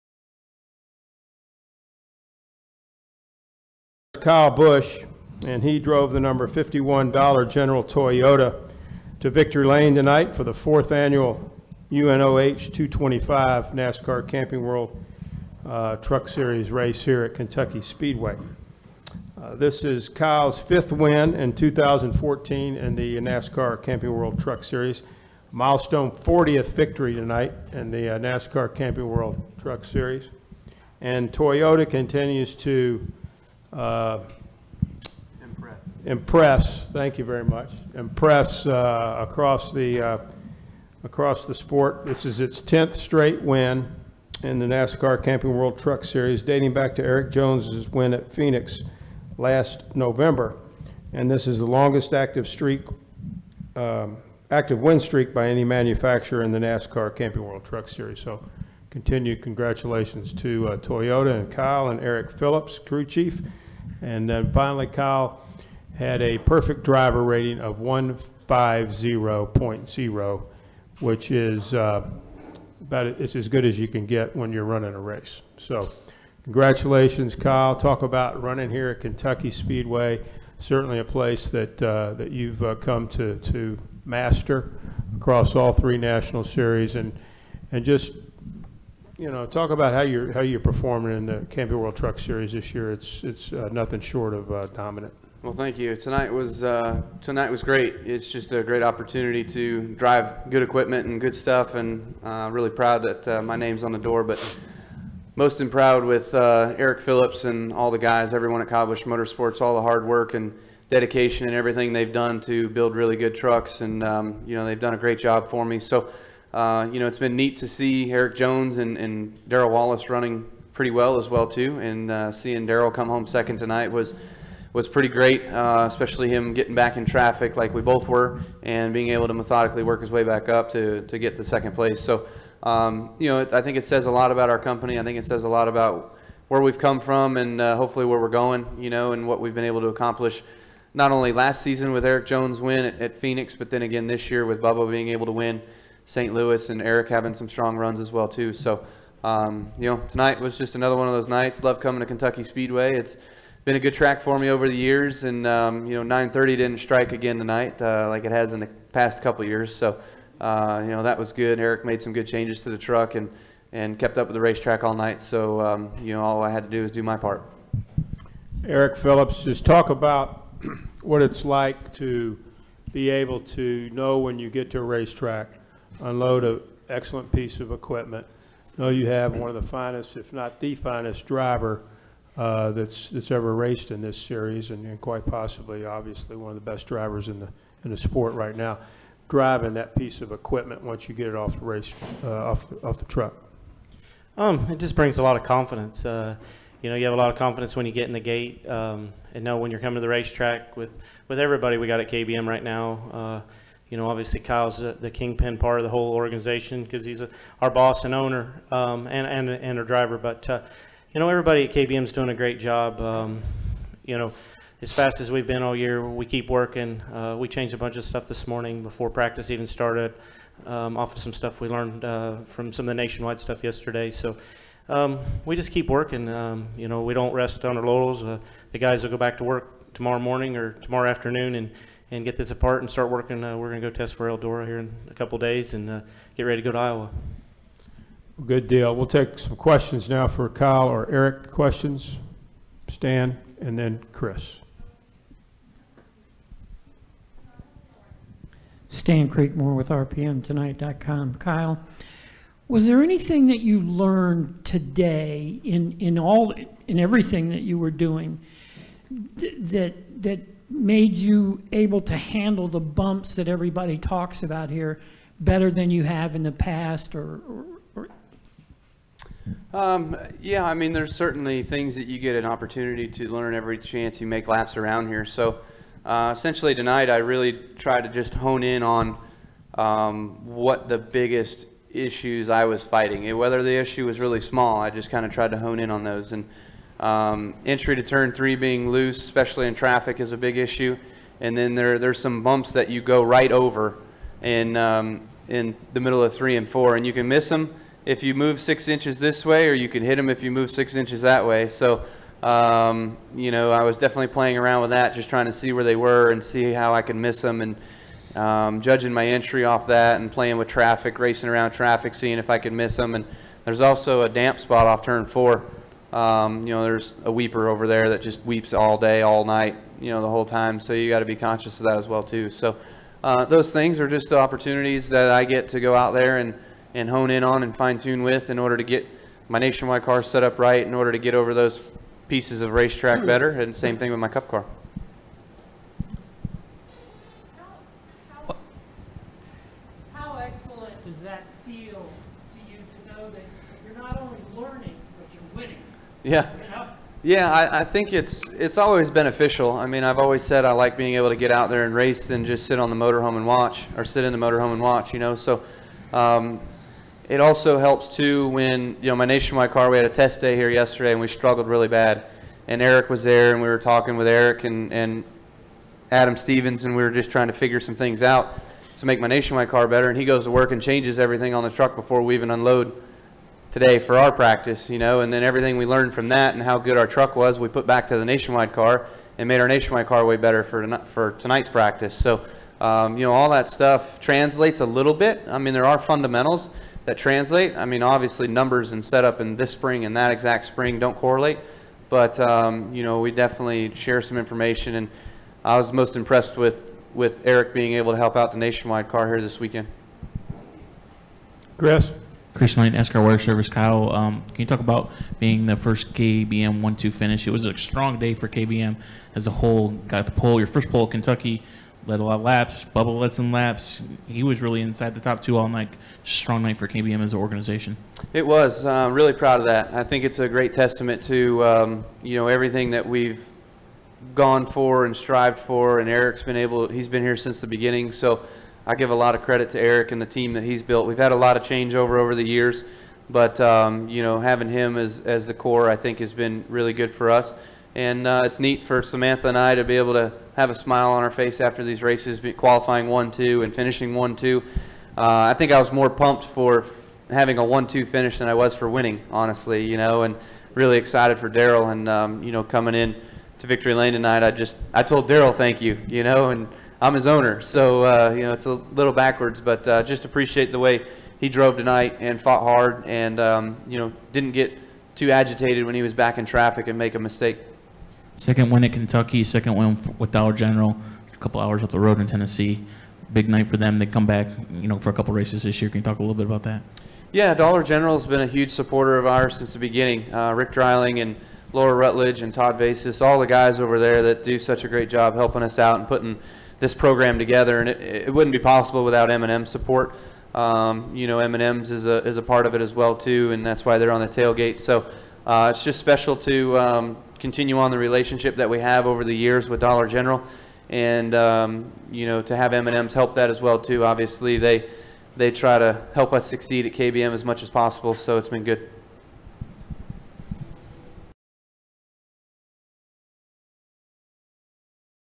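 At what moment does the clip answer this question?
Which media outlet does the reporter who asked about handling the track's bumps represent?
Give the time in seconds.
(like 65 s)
249 s.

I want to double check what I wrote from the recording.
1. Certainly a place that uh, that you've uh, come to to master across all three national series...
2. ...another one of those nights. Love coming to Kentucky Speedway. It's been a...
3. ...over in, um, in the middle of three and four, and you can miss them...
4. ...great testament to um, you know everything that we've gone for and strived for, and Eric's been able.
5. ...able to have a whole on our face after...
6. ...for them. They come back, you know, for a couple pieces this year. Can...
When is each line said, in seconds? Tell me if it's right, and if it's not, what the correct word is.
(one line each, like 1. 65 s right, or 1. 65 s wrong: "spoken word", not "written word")
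1. 80 s right
2. 150 s right
3. 293 s right
4. 420 s right
5. 439 s wrong: "smile", not "whole"
6. 473 s wrong: "races", not "pieces".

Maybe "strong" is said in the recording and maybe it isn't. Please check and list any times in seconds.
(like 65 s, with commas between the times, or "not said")
147 s, 407 s, 416 s.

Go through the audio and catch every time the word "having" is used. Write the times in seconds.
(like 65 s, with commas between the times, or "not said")
147 s, 434 s, 447 s.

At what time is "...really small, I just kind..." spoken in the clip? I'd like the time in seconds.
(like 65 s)
284 s.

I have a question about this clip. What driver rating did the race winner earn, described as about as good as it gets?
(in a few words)
150.0.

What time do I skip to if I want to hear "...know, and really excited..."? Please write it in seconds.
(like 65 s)
449 s.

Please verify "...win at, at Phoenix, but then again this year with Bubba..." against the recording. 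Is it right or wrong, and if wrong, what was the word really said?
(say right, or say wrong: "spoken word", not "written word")
right.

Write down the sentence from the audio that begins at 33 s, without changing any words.
Uh, impress, thank you very much, impress uh, across, the, uh, across the sport.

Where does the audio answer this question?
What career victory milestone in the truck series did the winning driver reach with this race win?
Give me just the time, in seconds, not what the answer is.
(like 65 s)
26 s.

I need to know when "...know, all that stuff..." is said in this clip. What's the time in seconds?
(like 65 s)
383 s.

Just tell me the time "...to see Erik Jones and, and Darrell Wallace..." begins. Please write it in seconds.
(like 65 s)
117 s.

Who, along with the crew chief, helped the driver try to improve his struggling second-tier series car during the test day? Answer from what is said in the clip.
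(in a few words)
Adam Stevens.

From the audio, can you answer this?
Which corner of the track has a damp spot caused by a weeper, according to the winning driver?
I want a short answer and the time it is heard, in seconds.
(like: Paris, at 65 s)
turn four, at 315 s.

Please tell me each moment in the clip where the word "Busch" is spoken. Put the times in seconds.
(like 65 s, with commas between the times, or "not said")
4 s, 108 s.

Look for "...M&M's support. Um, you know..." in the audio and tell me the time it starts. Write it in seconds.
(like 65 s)
489 s.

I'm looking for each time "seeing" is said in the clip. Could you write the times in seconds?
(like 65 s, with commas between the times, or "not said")
122 s, 312 s.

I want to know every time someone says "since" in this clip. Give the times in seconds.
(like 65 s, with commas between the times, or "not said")
427 s, 479 s.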